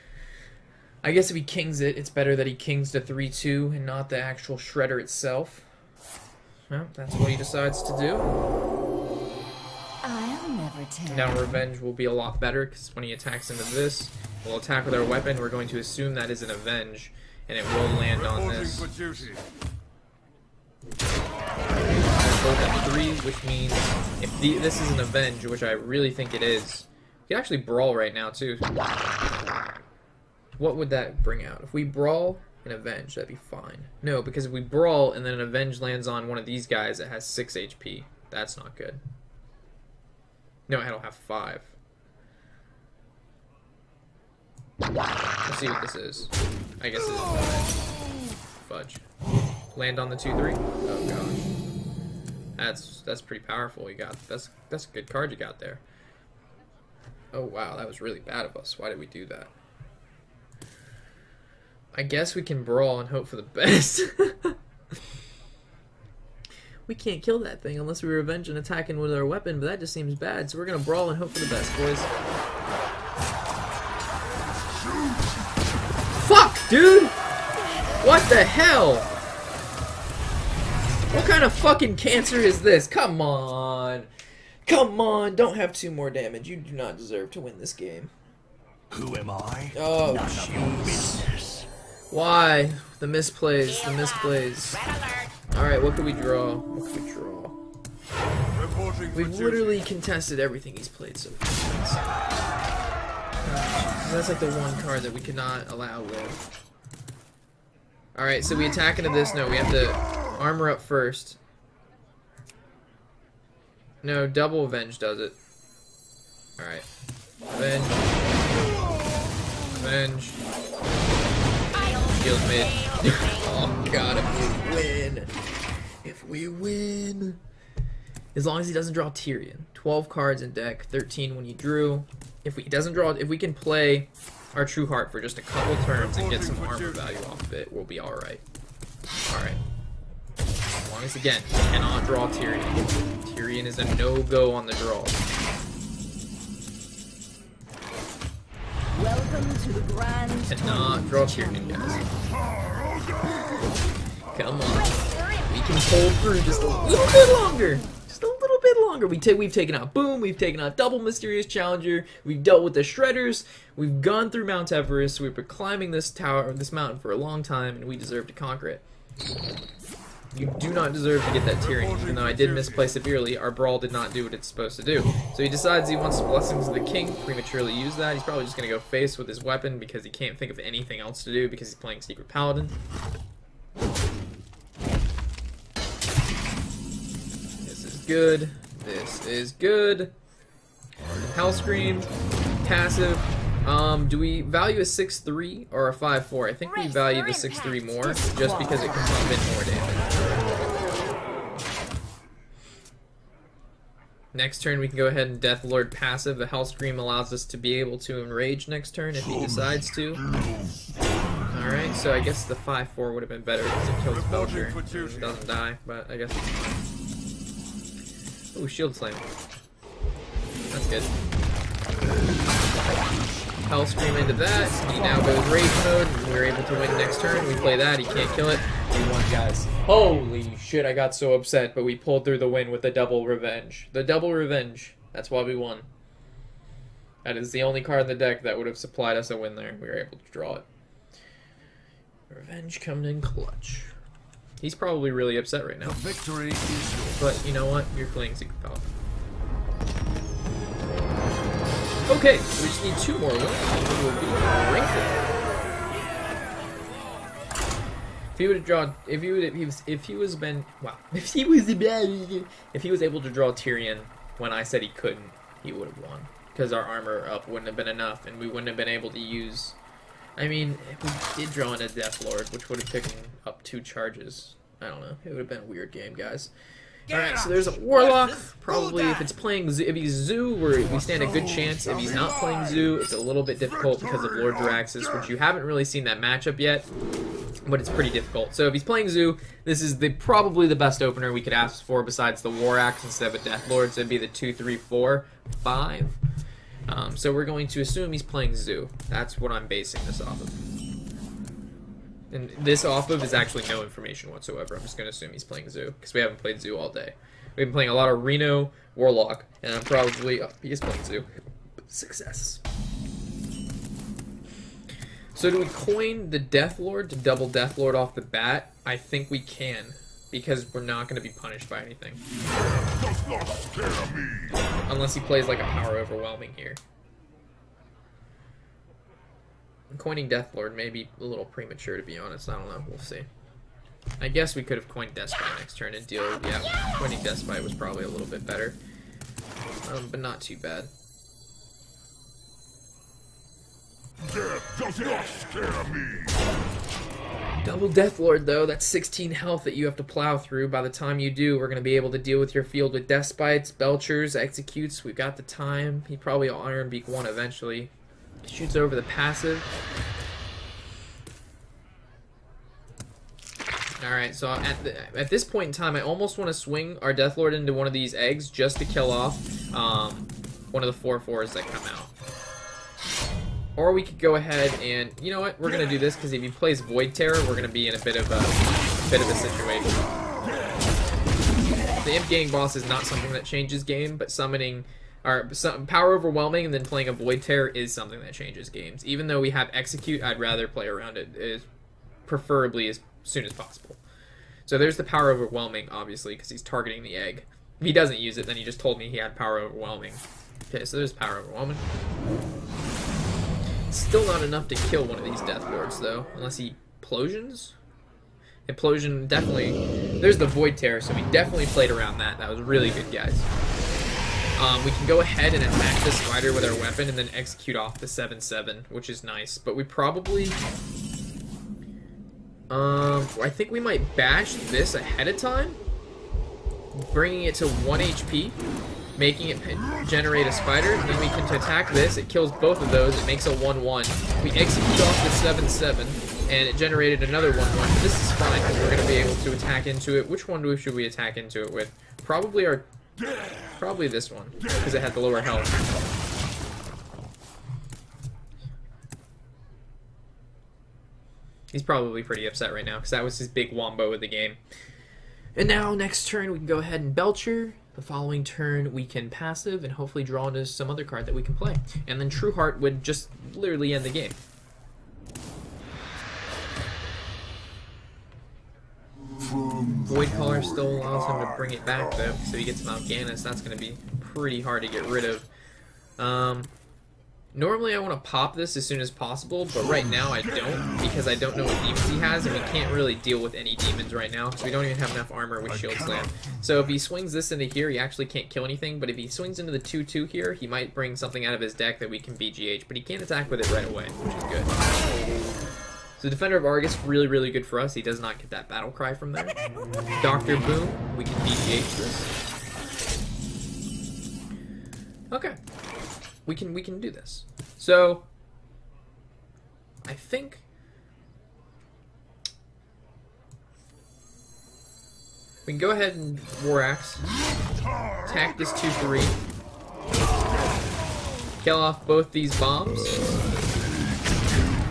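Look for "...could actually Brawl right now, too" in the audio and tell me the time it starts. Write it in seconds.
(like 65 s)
27 s.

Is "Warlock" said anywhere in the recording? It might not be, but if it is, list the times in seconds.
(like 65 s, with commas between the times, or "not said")
277 s, 308 s.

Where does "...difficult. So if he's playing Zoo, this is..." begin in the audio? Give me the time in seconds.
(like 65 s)
288 s.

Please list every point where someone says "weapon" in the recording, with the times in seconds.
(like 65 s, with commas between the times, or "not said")
15 s, 69 s, 179 s, 416 s.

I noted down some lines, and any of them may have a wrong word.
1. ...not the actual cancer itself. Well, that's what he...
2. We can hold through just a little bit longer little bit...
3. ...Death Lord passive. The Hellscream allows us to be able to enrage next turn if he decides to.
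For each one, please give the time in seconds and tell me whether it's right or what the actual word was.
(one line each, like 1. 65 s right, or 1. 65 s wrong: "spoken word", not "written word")
1. 3 s wrong: "shredder", not "cancer"
2. 155 s right
3. 205 s right.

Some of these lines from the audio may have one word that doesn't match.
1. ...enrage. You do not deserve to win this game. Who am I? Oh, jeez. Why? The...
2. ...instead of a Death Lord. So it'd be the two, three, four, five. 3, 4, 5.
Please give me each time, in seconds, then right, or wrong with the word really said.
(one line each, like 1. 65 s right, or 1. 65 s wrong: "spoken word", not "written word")
1. 86 s wrong: "damage", not "enrage"
2. 293 s right.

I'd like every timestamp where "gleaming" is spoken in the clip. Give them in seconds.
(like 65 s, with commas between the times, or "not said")
not said.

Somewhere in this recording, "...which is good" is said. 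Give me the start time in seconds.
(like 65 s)
494 s.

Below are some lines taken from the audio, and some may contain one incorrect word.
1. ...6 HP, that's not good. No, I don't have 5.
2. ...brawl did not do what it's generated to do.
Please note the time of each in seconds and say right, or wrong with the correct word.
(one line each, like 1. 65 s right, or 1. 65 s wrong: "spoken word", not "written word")
1. 37 s right
2. 173 s wrong: "supposed", not "generated".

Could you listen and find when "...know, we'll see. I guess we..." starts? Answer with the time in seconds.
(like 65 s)
332 s.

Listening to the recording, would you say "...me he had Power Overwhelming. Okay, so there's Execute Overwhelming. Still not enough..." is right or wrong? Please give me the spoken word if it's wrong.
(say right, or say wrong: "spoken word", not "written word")
wrong: "Power", not "Execute".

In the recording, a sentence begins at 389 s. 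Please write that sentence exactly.
Even though we have Execute, I'd rather play around it, is preferably as soon as possible.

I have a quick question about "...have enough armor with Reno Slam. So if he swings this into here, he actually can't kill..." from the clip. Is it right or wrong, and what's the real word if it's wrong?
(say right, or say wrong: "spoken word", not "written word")
wrong: "Shield", not "Reno".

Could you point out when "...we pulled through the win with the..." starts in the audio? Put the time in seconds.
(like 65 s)
231 s.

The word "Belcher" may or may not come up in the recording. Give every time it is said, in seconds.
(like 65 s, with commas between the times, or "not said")
214 s, 353 s, 457 s.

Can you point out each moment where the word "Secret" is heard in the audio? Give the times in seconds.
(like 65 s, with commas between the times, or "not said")
182 s, 248 s.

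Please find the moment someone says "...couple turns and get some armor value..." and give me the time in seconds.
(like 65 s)
135 s.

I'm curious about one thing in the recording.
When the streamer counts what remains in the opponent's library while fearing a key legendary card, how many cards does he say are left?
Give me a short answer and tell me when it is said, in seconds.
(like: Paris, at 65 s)
12, at 129 s.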